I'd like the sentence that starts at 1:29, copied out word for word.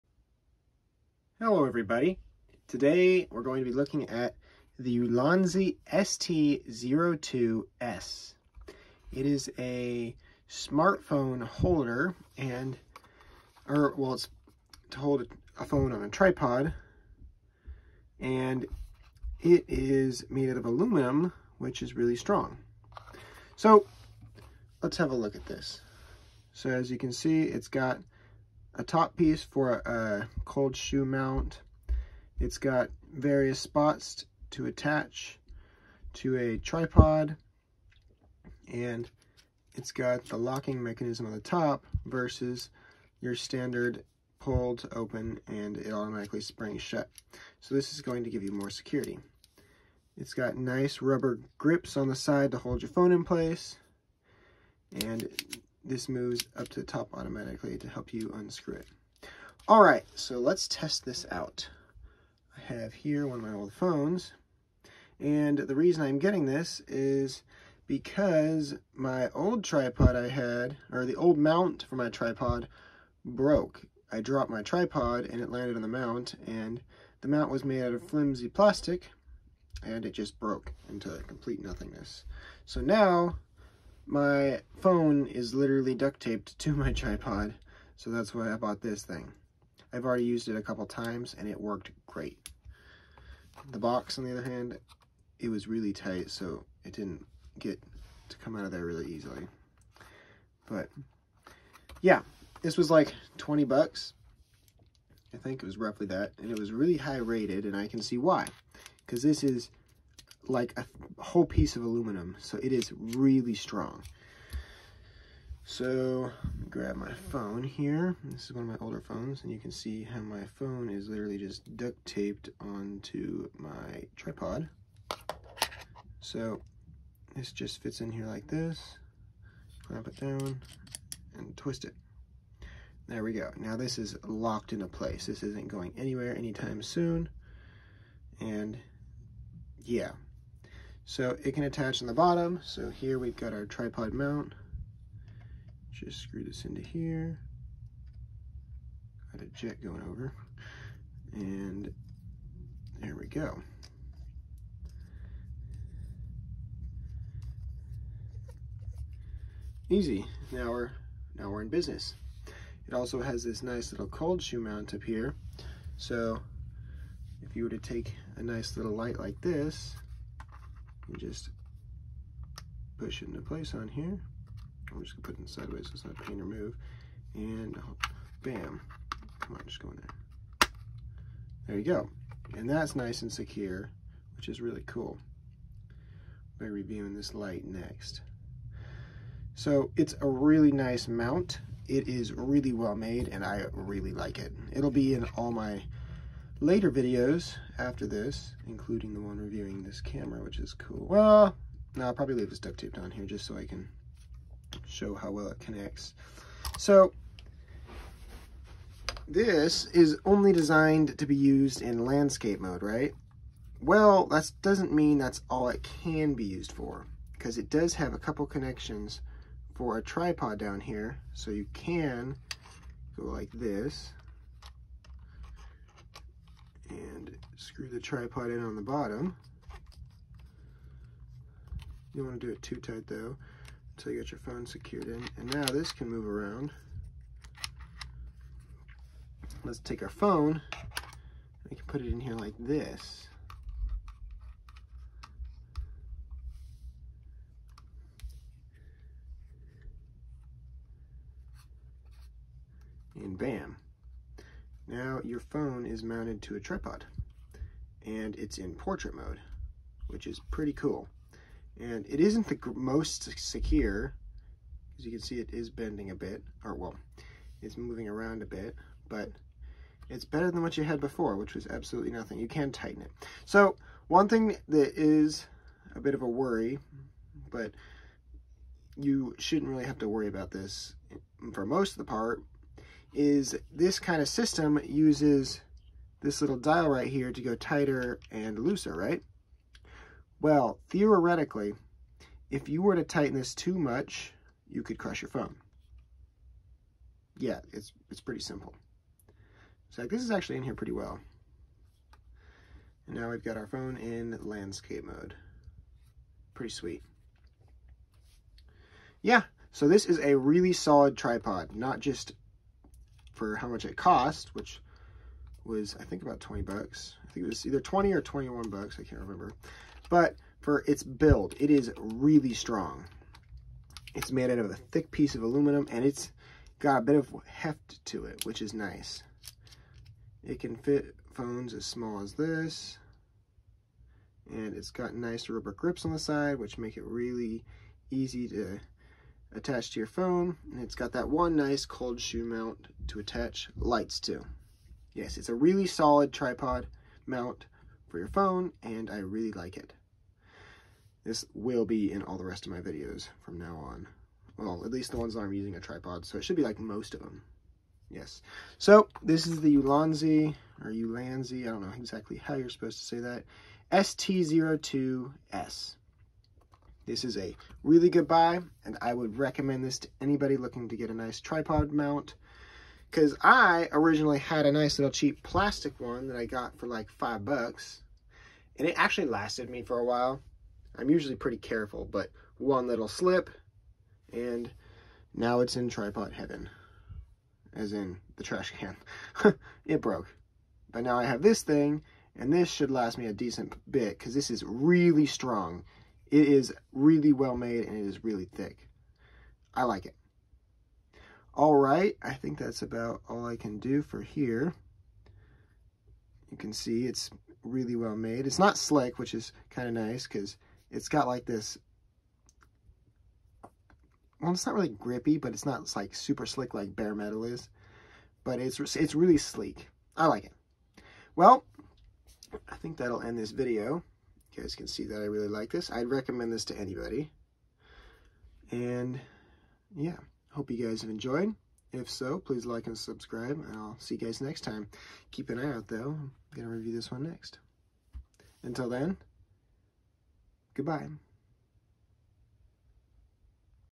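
I've already used it a couple times, and it worked great.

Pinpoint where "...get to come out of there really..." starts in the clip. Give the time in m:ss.
1:37.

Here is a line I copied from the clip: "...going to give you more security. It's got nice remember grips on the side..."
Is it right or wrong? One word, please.
wrong.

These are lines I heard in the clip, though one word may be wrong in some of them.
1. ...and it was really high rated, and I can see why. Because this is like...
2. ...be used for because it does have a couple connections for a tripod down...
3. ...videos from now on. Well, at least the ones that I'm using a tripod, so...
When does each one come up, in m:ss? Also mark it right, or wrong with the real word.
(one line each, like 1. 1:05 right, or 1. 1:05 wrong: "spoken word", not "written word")
1. 1:46 right
2. 3:36 right
3. 5:52 right.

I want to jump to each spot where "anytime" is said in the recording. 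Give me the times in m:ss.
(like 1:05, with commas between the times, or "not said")
2:16.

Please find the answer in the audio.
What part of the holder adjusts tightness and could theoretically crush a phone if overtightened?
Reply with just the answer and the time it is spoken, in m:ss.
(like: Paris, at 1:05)
little dial, at 4:46.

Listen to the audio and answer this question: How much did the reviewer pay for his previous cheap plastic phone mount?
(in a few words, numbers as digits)
$5.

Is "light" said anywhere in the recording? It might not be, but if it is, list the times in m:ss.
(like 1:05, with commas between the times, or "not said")
2:48, 3:07, 5:43.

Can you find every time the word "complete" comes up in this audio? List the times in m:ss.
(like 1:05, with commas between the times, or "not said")
1:21.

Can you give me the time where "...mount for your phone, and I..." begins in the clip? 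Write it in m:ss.
5:47.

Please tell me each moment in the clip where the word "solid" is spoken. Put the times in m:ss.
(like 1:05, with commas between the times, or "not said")
5:10, 5:45.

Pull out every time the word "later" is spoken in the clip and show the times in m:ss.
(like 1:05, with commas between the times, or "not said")
3:16.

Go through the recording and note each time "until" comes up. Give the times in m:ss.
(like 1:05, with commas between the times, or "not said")
3:53, 7:18.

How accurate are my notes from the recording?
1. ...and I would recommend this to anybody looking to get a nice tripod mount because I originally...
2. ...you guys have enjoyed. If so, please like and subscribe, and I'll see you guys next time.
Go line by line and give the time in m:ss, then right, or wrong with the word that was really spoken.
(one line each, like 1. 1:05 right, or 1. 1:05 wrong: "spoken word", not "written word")
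1. 6:08 right
2. 7:10 right.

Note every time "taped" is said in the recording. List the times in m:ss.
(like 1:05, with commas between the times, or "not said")
1:26, 2:02, 3:22.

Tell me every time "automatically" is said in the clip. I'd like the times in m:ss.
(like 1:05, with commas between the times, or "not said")
0:45, 0:57.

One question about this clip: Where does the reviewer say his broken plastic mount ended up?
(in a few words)
trash can.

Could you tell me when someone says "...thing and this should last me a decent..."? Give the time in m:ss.
6:31.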